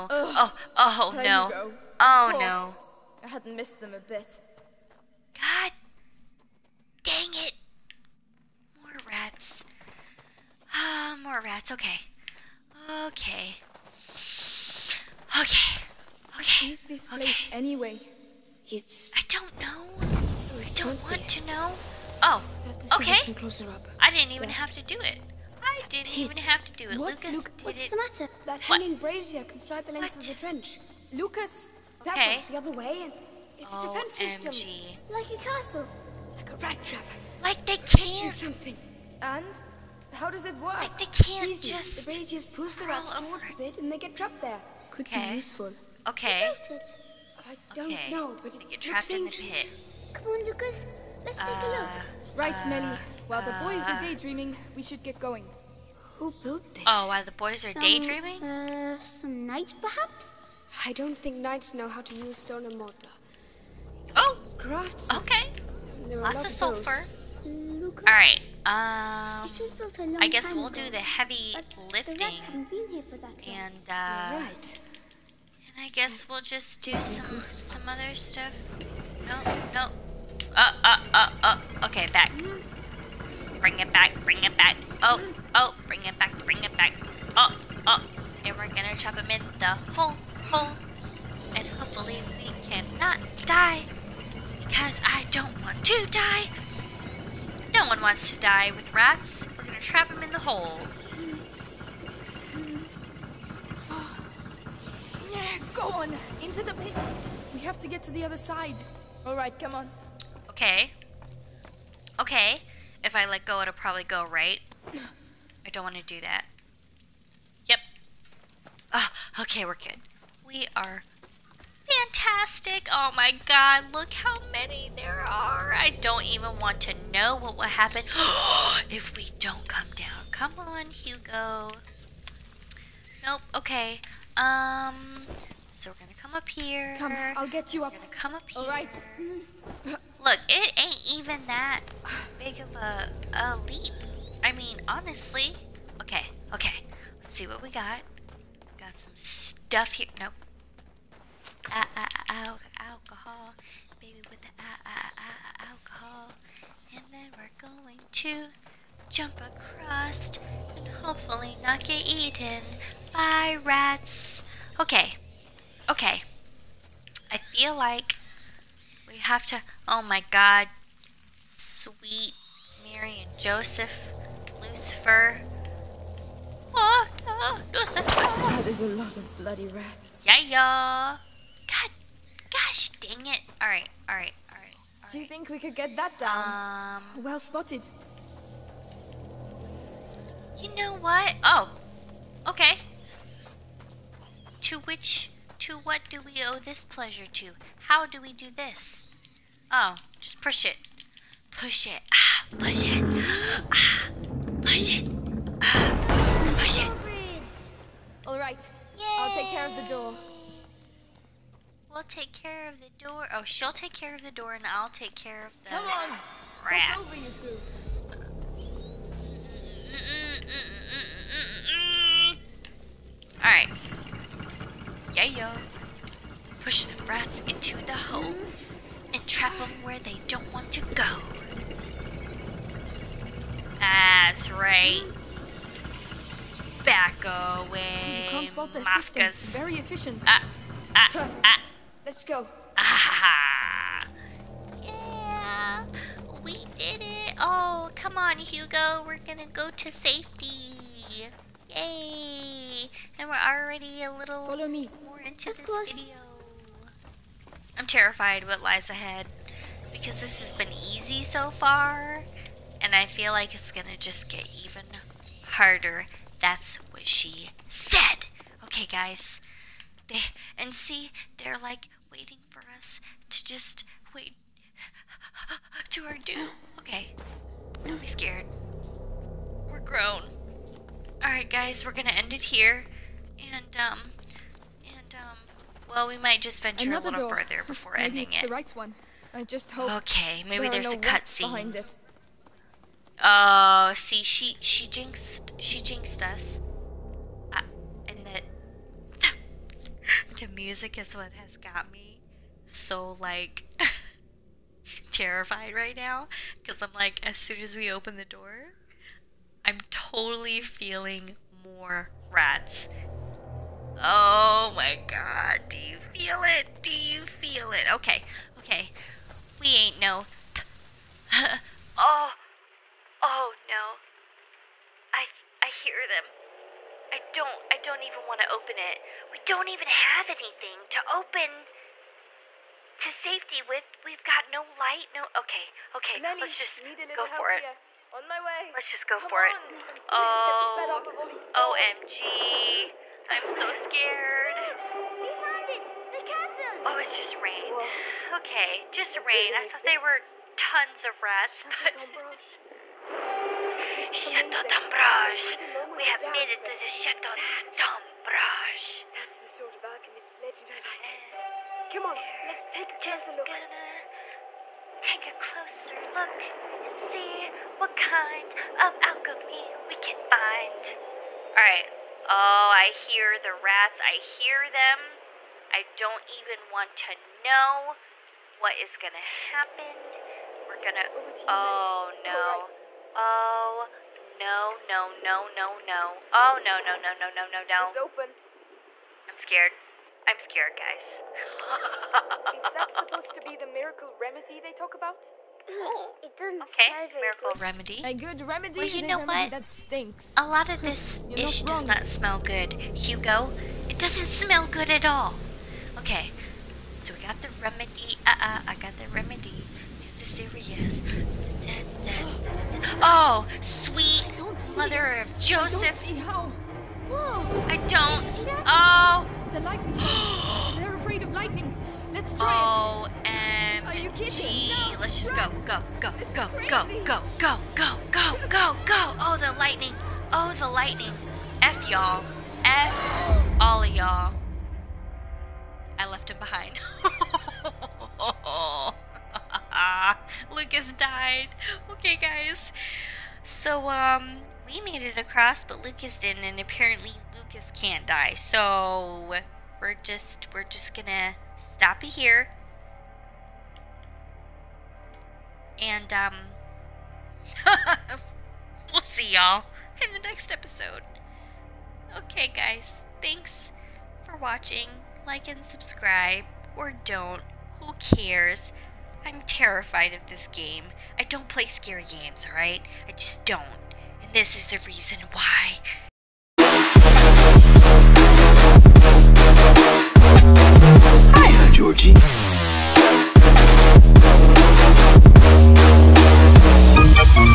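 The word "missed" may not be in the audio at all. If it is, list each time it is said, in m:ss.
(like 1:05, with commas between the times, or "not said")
0:03.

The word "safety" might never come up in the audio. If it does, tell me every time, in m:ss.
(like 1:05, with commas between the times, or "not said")
4:09, 5:33.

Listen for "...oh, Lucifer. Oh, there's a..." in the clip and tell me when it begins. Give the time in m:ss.
2:57.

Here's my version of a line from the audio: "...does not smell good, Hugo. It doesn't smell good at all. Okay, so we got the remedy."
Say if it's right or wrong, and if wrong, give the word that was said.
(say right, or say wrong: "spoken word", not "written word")
right.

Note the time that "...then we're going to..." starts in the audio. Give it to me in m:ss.
2:37.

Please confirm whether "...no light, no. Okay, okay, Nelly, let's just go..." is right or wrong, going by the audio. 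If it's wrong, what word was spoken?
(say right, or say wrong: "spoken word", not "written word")
right.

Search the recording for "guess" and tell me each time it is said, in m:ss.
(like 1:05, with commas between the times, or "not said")
1:10, 1:15.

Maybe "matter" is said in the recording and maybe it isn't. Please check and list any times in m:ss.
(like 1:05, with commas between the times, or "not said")
0:27.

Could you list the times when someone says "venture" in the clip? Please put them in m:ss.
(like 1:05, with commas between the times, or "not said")
4:46.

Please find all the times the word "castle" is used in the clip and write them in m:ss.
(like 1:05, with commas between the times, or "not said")
0:35, 5:46.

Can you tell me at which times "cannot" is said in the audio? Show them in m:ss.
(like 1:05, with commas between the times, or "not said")
1:32.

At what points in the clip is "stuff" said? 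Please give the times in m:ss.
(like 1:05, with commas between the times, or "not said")
1:18, 2:29.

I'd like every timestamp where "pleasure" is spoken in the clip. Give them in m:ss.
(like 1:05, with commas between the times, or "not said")
3:16.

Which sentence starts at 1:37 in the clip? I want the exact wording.
No one wants to die with rats.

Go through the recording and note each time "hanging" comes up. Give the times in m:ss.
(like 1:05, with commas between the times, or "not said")
0:28.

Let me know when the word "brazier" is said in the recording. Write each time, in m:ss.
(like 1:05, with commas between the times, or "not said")
0:28, 0:42.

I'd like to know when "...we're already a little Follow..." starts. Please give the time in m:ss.
4:13.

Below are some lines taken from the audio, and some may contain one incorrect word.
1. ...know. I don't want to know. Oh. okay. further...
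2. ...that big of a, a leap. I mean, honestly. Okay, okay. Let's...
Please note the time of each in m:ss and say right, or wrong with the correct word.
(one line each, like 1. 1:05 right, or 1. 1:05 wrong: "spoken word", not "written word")
1. 0:19 wrong: "closer", not "further"
2. 2:21 right.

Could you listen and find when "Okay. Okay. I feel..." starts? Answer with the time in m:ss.
2:44.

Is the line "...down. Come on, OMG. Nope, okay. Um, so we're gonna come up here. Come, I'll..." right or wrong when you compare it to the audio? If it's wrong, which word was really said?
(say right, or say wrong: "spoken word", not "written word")
wrong: "Hugo", not "OMG".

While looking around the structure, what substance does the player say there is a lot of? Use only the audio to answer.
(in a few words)
Sulfur.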